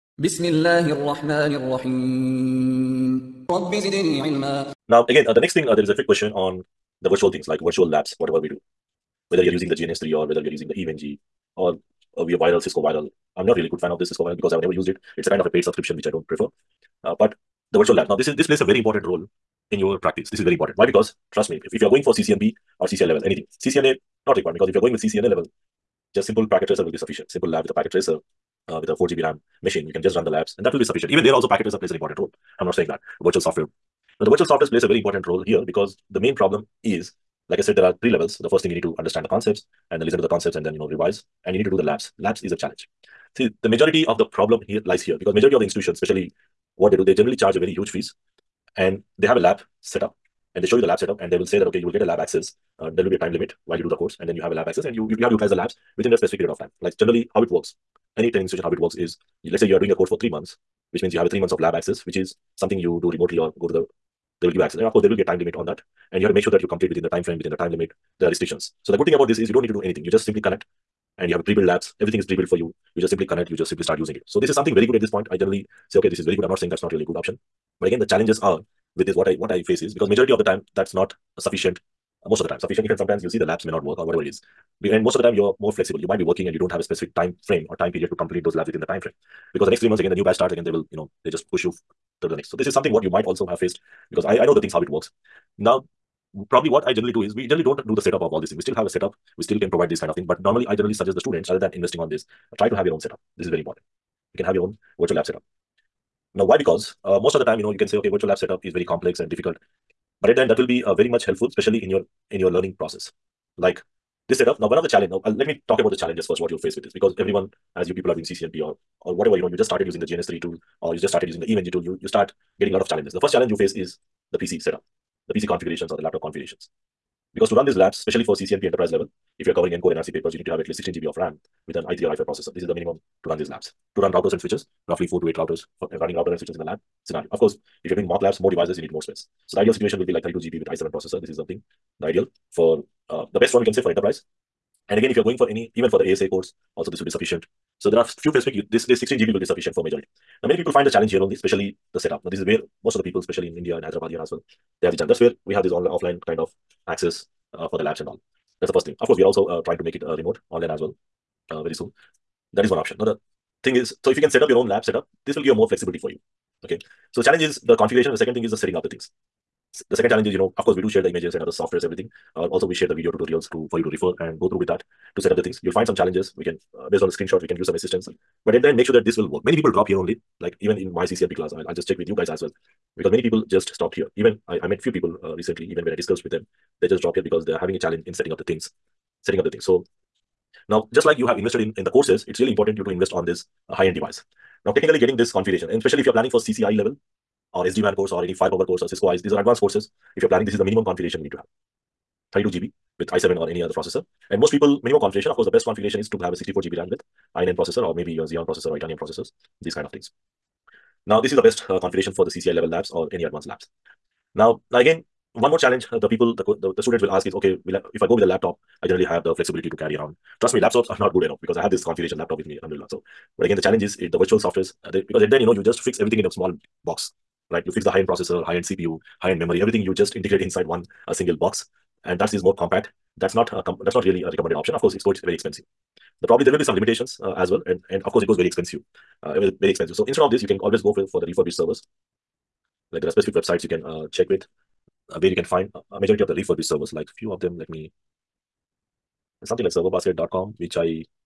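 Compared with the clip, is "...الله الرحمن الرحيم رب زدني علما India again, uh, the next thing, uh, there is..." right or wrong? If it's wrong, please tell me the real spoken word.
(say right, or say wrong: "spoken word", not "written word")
wrong: "Now", not "India".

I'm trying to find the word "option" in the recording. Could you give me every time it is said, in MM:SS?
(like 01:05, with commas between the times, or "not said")
01:17, 02:42, 03:54.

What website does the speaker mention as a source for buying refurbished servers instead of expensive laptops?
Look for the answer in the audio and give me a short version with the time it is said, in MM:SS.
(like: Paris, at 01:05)
serverbasket.com, at 04:09.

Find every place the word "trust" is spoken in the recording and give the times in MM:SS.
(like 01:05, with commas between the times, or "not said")
00:21, 03:40.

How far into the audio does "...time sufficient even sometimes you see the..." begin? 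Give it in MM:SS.
01:22.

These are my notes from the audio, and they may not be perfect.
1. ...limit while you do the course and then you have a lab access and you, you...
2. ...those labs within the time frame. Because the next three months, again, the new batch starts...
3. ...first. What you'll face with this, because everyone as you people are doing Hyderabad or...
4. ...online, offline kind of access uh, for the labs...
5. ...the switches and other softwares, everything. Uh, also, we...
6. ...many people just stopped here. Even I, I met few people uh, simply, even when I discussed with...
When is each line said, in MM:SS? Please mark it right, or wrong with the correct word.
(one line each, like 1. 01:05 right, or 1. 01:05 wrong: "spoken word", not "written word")
1. 00:53 right
2. 01:28 right
3. 01:56 wrong: "CCNP", not "Hyderabad"
4. 02:35 right
5. 02:51 wrong: "images", not "switches"
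6. 03:03 wrong: "recently", not "simply".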